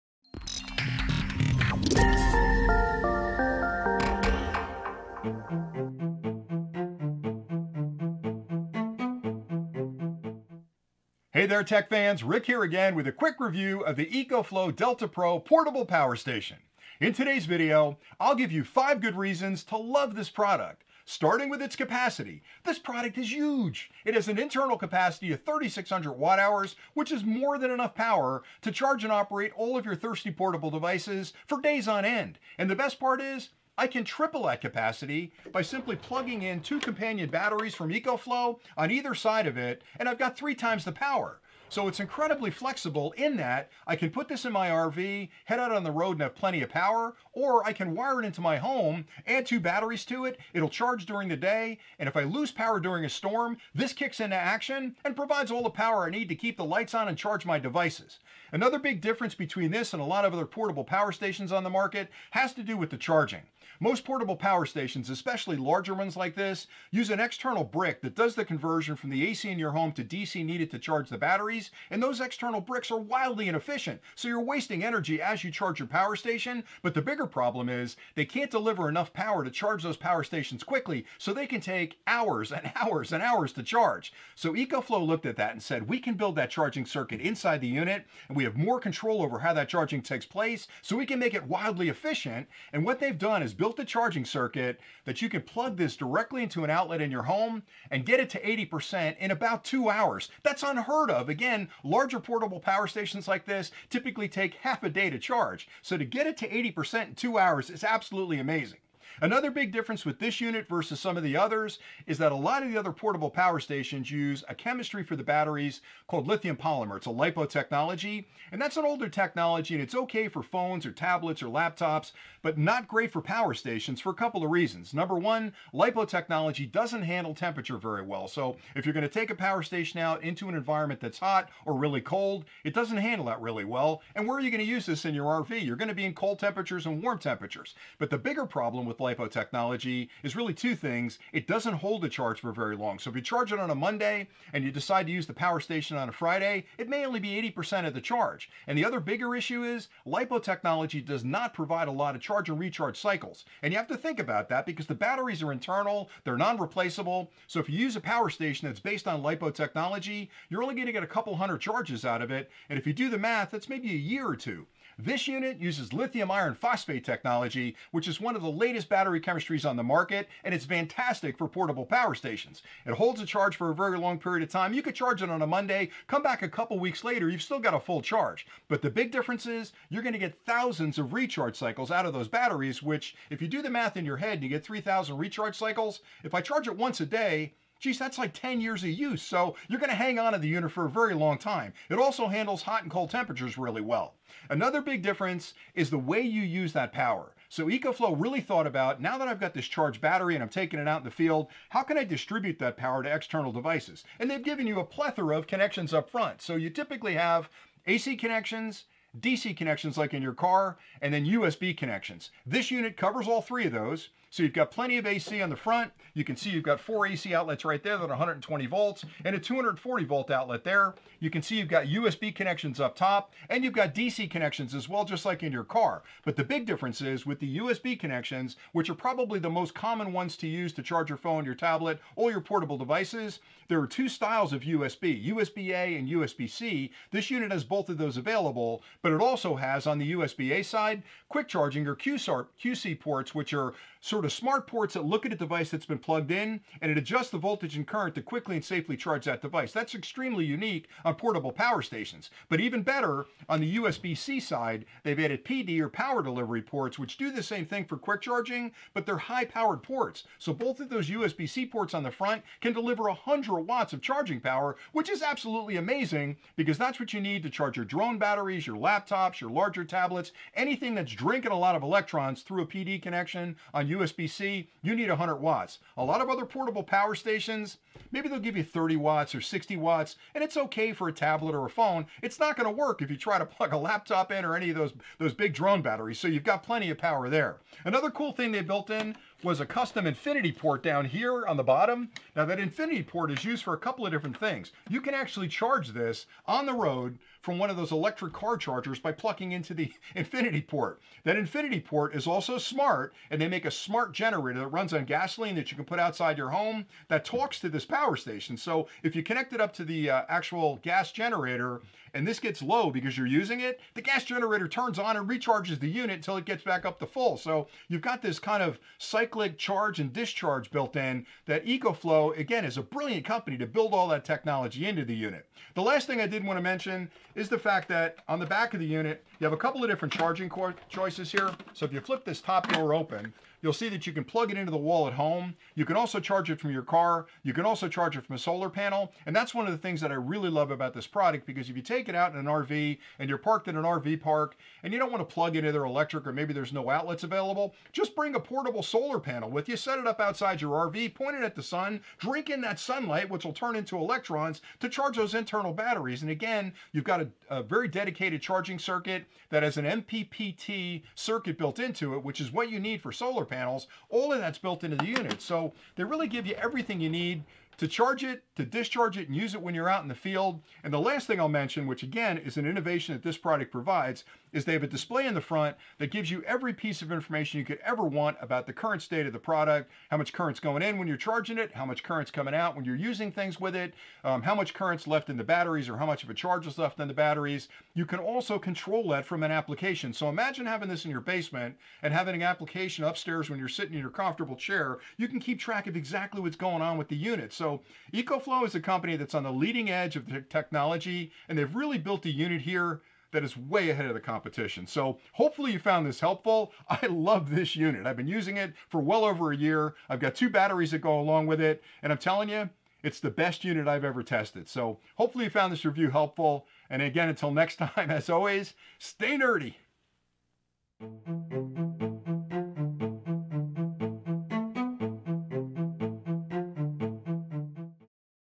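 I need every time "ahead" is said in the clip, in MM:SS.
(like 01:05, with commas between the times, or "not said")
06:43.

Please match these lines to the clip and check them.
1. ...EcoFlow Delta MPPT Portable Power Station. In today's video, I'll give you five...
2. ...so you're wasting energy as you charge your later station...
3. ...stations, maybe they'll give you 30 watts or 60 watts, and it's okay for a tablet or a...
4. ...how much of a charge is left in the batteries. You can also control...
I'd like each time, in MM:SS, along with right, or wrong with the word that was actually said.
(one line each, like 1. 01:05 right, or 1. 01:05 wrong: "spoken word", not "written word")
1. 00:14 wrong: "Pro", not "MPPT"
2. 01:14 wrong: "power", not "later"
3. 04:37 right
4. 06:25 right.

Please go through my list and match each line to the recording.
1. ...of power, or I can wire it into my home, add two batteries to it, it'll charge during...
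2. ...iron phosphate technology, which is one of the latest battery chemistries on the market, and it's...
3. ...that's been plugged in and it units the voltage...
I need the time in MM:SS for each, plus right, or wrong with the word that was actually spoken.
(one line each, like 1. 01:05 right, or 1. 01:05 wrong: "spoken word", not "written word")
1. 00:46 right
2. 02:46 right
3. 04:05 wrong: "adjusts", not "units".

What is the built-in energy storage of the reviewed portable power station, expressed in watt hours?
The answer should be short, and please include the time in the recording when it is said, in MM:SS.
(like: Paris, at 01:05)
3,600 watt hours, at 00:25.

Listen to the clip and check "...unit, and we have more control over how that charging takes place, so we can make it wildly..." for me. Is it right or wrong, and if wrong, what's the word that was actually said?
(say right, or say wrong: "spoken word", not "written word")
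right.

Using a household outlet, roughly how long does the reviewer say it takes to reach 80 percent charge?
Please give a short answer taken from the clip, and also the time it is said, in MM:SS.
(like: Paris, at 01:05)
about two hours, at 01:39.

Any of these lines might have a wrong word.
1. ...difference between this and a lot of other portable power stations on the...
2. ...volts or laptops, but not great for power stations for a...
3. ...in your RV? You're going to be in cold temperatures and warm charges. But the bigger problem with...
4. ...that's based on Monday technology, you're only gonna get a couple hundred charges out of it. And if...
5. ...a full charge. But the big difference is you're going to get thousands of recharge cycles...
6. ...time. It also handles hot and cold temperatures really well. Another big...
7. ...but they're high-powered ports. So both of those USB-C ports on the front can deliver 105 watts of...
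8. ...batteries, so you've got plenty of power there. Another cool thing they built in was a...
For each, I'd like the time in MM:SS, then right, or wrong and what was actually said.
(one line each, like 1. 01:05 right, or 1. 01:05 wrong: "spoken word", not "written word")
1. 00:59 right
2. 02:00 wrong: "tablets", not "volts"
3. 02:15 wrong: "temperatures", not "charges"
4. 02:38 wrong: "LiPo", not "Monday"
5. 02:57 right
6. 03:11 right
7. 04:18 wrong: "100", not "105"
8. 04:45 right.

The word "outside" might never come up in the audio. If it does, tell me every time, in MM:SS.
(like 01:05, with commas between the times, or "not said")
05:05, 05:50.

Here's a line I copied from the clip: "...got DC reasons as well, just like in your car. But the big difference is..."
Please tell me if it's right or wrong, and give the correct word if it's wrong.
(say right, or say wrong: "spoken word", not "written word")
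wrong: "connections", not "reasons".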